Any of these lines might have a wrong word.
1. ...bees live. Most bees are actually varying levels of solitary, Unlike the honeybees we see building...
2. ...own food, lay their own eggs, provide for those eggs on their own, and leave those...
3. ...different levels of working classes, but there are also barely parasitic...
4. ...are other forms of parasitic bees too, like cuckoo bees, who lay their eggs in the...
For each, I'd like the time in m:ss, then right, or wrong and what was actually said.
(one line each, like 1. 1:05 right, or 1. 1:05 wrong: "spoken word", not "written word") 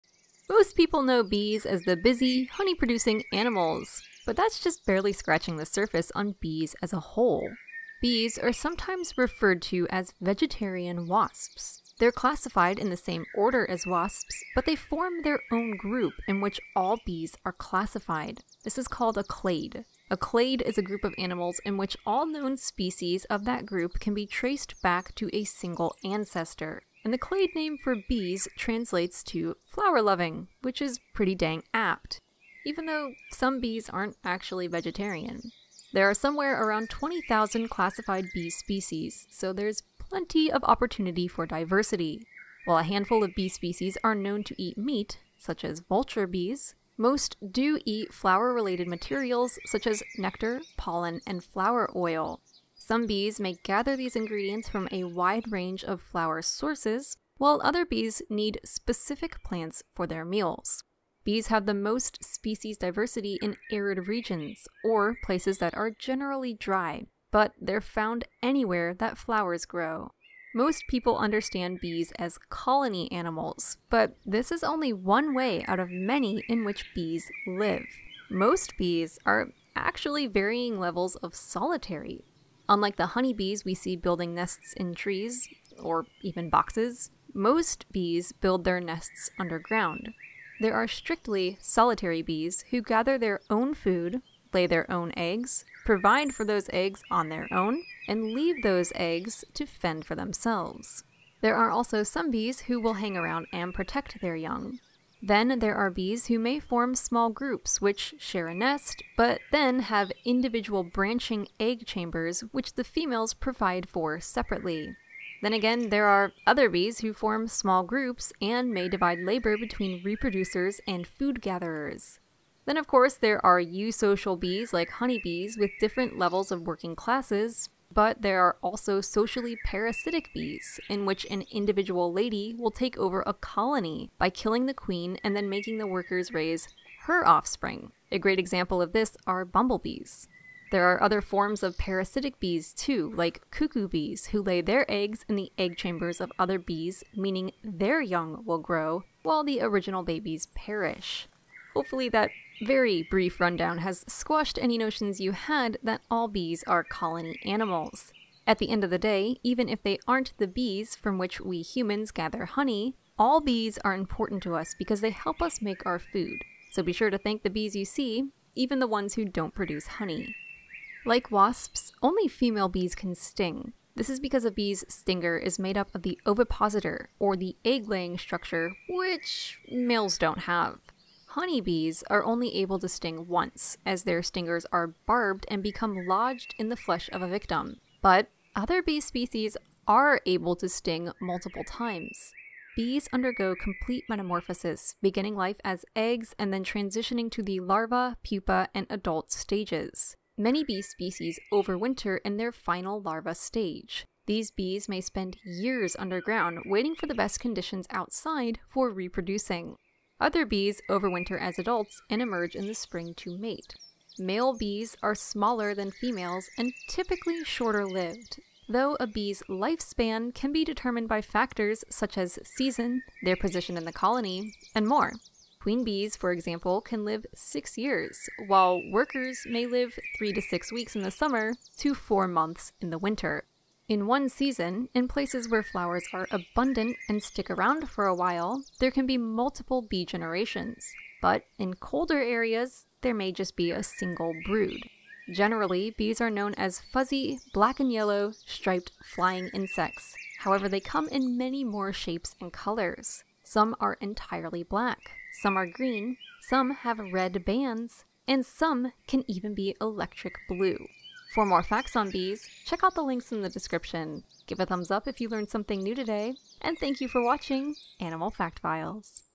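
1. 1:16 right
2. 1:33 right
3. 2:05 wrong: "socially", not "barely"
4. 2:20 right.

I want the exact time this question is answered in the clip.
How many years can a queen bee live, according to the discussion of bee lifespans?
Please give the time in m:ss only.
3:47.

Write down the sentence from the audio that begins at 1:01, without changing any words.
Bees have the most species diversity in arid regions, or places that are generally dry, but they're found anywhere that flowers grow.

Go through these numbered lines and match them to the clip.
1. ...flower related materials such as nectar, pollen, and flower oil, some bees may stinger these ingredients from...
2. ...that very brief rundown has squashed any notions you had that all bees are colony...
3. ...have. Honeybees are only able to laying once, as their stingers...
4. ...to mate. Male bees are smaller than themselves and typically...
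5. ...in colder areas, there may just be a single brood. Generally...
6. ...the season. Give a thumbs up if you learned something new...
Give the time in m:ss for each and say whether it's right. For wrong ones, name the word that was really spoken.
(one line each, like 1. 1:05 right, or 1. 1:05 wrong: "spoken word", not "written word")
1. 0:48 wrong: "gather", not "stinger"
2. 2:32 right
3. 3:00 wrong: "sting", not "laying"
4. 3:33 wrong: "females", not "themselves"
5. 4:01 right
6. 4:23 wrong: "description", not "season".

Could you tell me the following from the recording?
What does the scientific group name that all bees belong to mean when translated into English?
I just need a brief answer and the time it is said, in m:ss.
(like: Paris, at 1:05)
flower loving, at 0:29.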